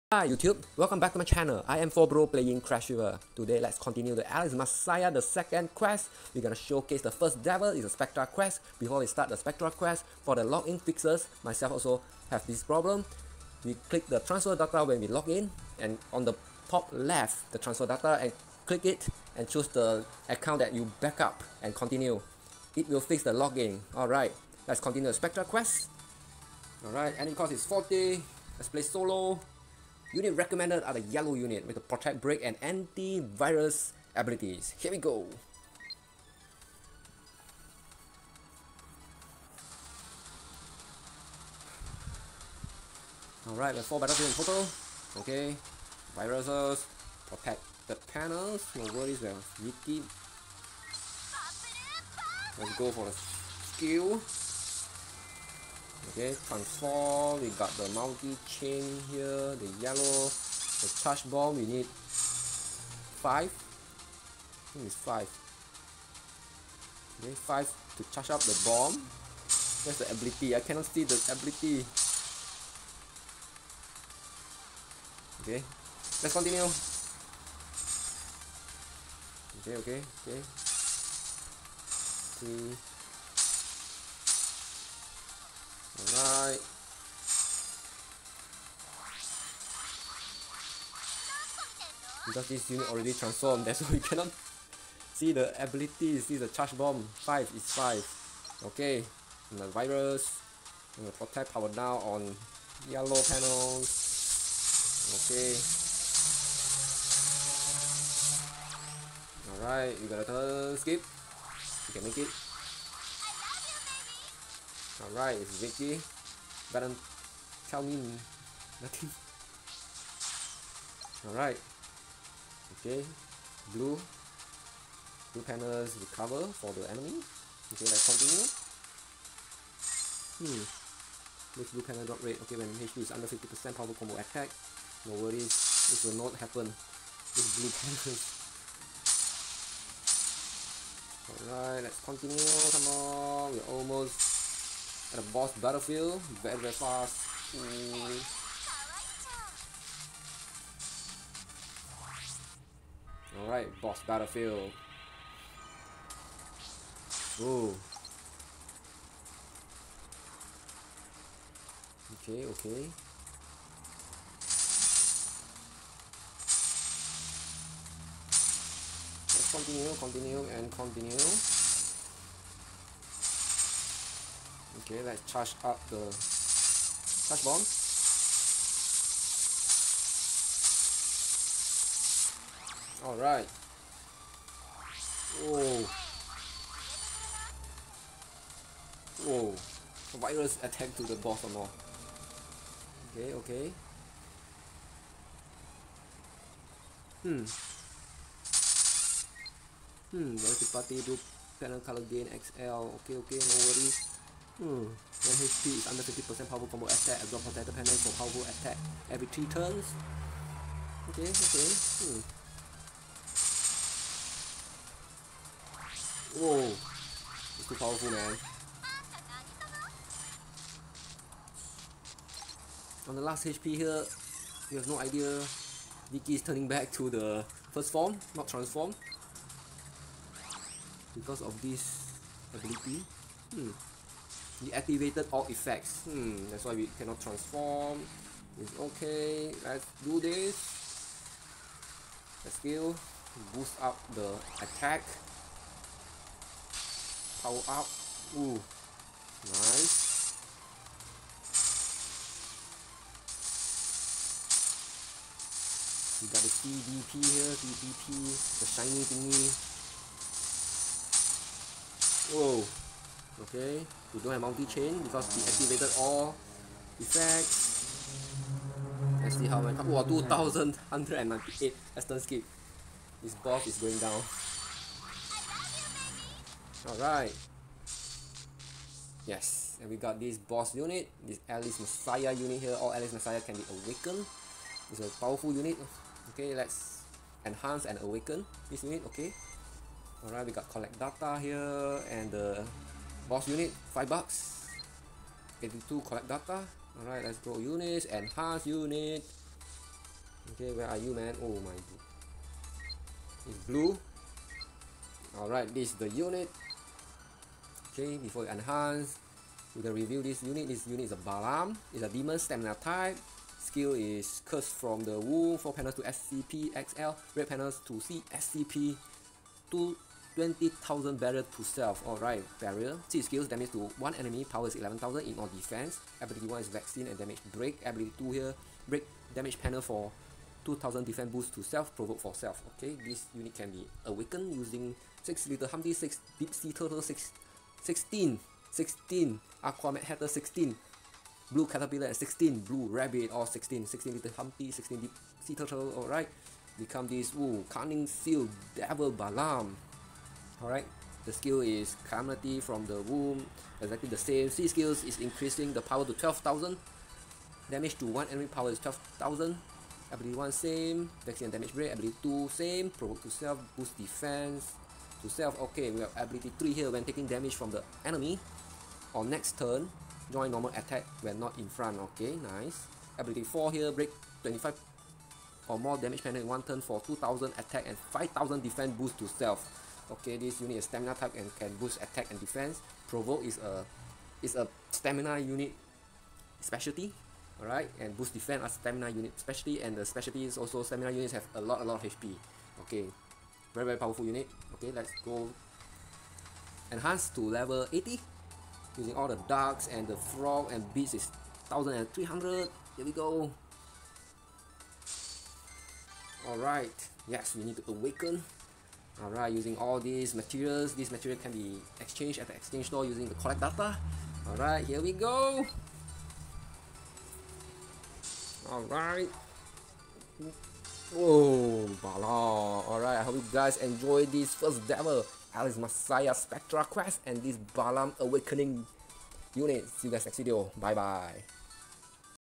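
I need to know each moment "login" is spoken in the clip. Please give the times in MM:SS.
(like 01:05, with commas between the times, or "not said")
00:10, 00:23.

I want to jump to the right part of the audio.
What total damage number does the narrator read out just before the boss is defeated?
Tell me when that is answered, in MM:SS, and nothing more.
04:30.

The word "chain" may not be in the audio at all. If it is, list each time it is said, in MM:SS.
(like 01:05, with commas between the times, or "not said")
00:58, 04:24.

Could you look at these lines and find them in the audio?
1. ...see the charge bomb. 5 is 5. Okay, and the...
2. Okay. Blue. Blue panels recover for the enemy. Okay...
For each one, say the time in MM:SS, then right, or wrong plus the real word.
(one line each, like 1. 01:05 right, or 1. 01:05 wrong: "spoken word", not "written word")
1. 01:36 right
2. 02:02 right.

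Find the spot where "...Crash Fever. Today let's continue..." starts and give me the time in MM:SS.
00:02.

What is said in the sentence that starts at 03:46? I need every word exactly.
Vicky is turning back to the first form, not transform.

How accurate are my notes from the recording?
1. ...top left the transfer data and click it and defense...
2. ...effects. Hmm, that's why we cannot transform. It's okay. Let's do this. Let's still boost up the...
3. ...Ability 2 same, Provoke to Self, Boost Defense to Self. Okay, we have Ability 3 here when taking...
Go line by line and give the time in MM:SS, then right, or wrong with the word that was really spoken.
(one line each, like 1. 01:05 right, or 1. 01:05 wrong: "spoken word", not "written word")
1. 00:16 wrong: "choose", not "defense"
2. 03:55 right
3. 06:01 right.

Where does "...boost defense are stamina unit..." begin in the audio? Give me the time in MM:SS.
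06:28.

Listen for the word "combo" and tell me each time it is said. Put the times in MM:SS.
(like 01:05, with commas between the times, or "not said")
02:13, 03:26.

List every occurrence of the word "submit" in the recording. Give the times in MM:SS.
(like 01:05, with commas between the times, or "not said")
not said.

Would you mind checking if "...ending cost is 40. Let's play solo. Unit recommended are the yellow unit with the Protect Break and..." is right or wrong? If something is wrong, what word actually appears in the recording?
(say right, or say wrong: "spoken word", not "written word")
right.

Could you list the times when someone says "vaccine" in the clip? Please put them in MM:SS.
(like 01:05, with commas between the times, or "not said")
05:26, 06:01.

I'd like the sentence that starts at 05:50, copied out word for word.
Alright, the skill is Calamity from the Womb, exactly the same.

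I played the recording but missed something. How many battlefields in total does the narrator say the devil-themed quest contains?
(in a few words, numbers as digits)
4.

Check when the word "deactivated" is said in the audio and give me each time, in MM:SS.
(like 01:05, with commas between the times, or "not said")
03:54.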